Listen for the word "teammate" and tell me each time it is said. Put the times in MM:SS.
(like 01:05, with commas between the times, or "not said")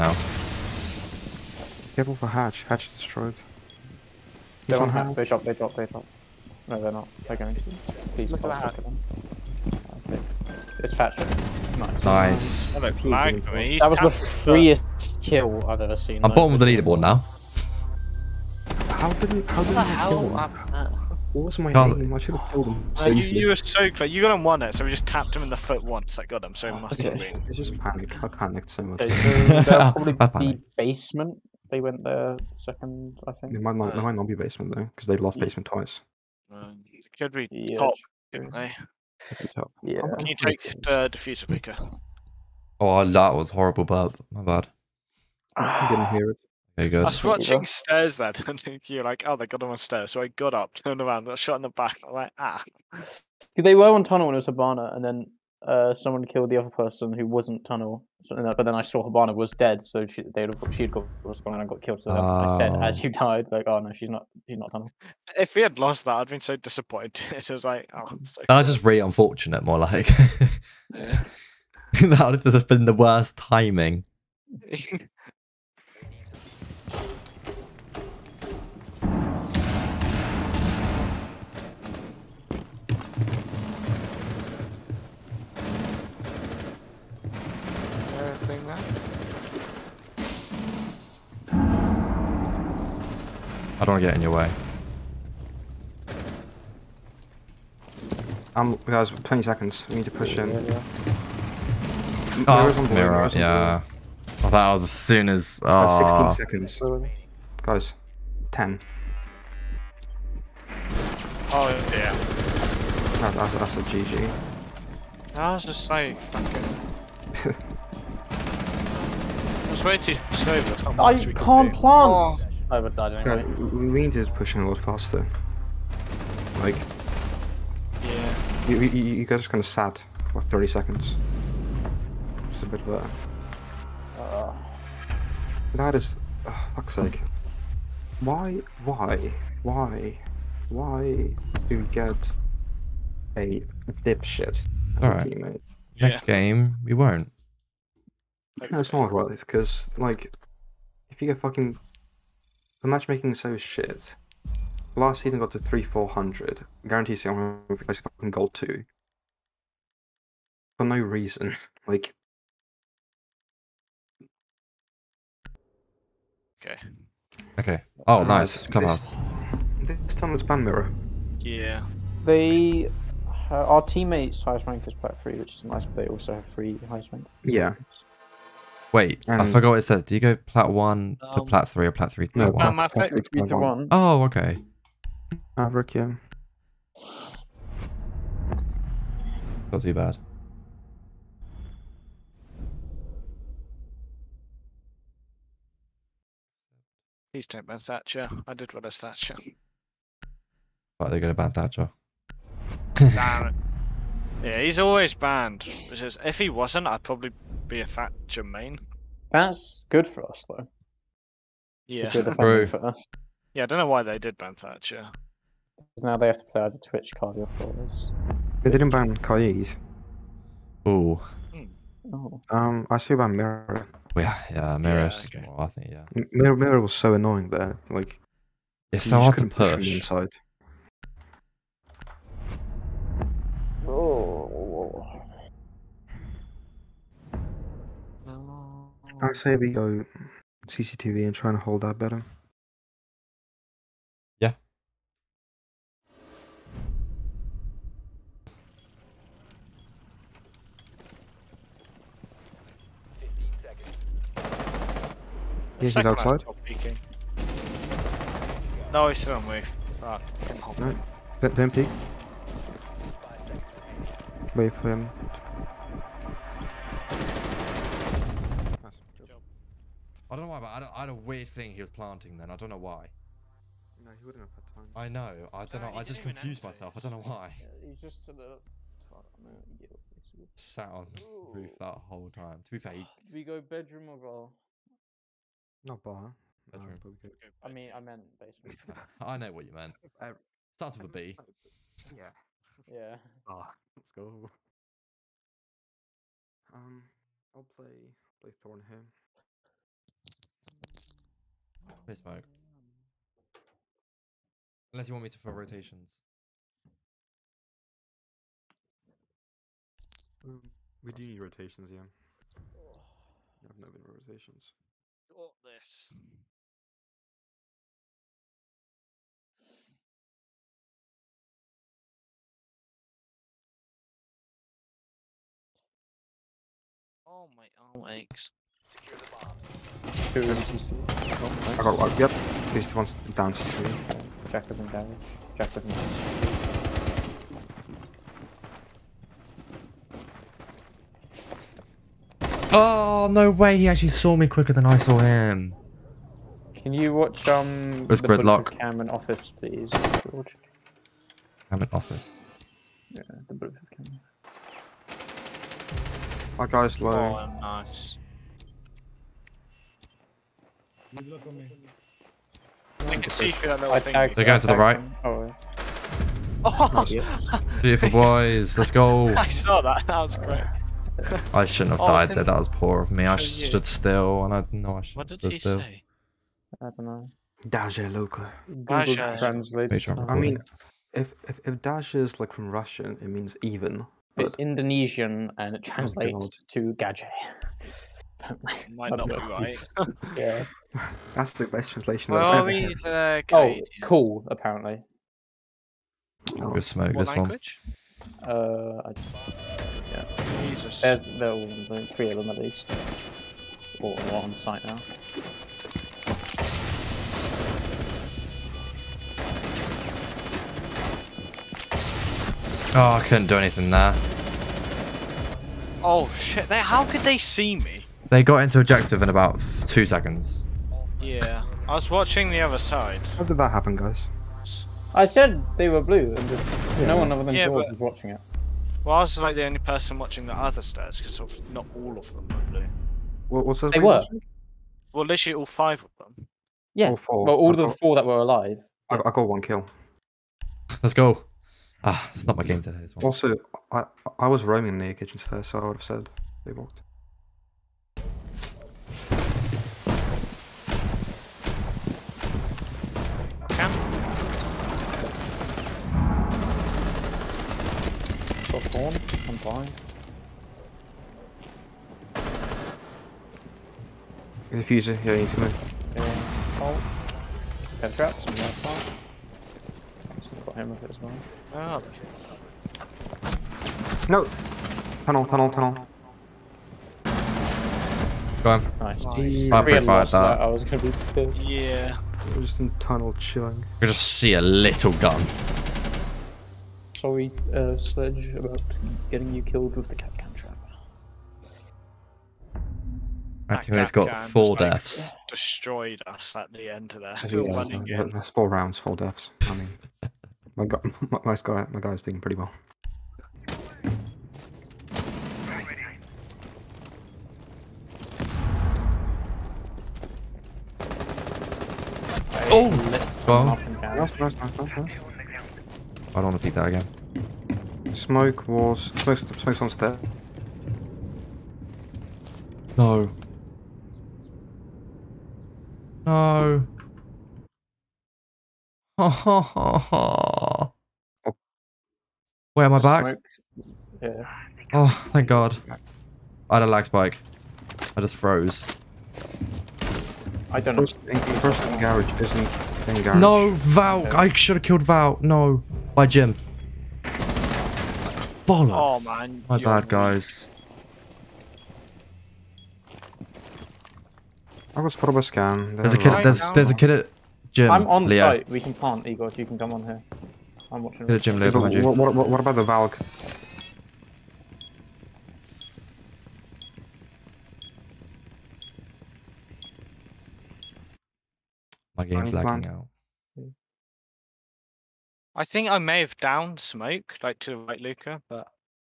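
02:25, 02:53.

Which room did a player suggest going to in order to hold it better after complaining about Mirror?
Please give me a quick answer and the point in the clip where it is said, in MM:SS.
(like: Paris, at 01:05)
CCTV, at 04:00.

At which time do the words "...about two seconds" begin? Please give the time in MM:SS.
06:59.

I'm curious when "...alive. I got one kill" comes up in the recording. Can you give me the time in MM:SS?
07:18.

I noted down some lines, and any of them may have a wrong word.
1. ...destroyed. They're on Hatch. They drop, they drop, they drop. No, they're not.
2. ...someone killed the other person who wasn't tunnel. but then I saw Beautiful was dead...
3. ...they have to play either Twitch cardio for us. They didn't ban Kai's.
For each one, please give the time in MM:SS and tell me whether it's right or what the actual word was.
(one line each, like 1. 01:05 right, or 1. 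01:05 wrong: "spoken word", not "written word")
1. 00:02 right
2. 00:55 wrong: "Habana", not "Beautiful"
3. 03:36 right.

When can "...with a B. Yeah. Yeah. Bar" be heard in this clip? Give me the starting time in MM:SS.
04:50.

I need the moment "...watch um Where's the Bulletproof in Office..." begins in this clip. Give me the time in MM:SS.
05:47.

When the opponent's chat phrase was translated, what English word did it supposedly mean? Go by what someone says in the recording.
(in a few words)
gadget.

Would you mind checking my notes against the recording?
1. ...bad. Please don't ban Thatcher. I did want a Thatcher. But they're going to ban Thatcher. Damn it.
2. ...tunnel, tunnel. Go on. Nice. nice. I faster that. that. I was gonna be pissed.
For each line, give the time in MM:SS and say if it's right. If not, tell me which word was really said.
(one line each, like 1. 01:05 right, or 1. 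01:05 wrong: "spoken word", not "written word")
1. 03:09 right
2. 07:55 wrong: "prefer", not "faster".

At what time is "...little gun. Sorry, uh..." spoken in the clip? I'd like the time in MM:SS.
08:04.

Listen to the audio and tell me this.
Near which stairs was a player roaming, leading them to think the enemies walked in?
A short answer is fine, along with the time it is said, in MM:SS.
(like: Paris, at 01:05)
Kitchen stairs, at 07:25.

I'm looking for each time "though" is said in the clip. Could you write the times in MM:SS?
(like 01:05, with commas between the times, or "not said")
00:34, 03:30.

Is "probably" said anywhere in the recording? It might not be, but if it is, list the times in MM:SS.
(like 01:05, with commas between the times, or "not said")
00:29, 03:27.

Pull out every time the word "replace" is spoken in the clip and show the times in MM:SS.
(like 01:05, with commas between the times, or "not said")
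02:37.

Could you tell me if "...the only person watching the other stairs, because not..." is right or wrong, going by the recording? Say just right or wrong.
right.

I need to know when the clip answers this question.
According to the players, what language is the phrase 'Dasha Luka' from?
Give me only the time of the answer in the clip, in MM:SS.
06:24.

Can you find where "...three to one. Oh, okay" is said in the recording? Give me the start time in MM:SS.
03:02.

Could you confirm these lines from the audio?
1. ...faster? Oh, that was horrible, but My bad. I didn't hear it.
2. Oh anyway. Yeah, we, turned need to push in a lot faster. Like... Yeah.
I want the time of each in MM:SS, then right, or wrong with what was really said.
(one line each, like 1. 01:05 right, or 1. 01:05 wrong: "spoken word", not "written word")
1. 00:41 wrong: "maker", not "faster"
2. 02:02 wrong: "needed", not "turned".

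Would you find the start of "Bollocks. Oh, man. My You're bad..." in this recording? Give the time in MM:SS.
09:08.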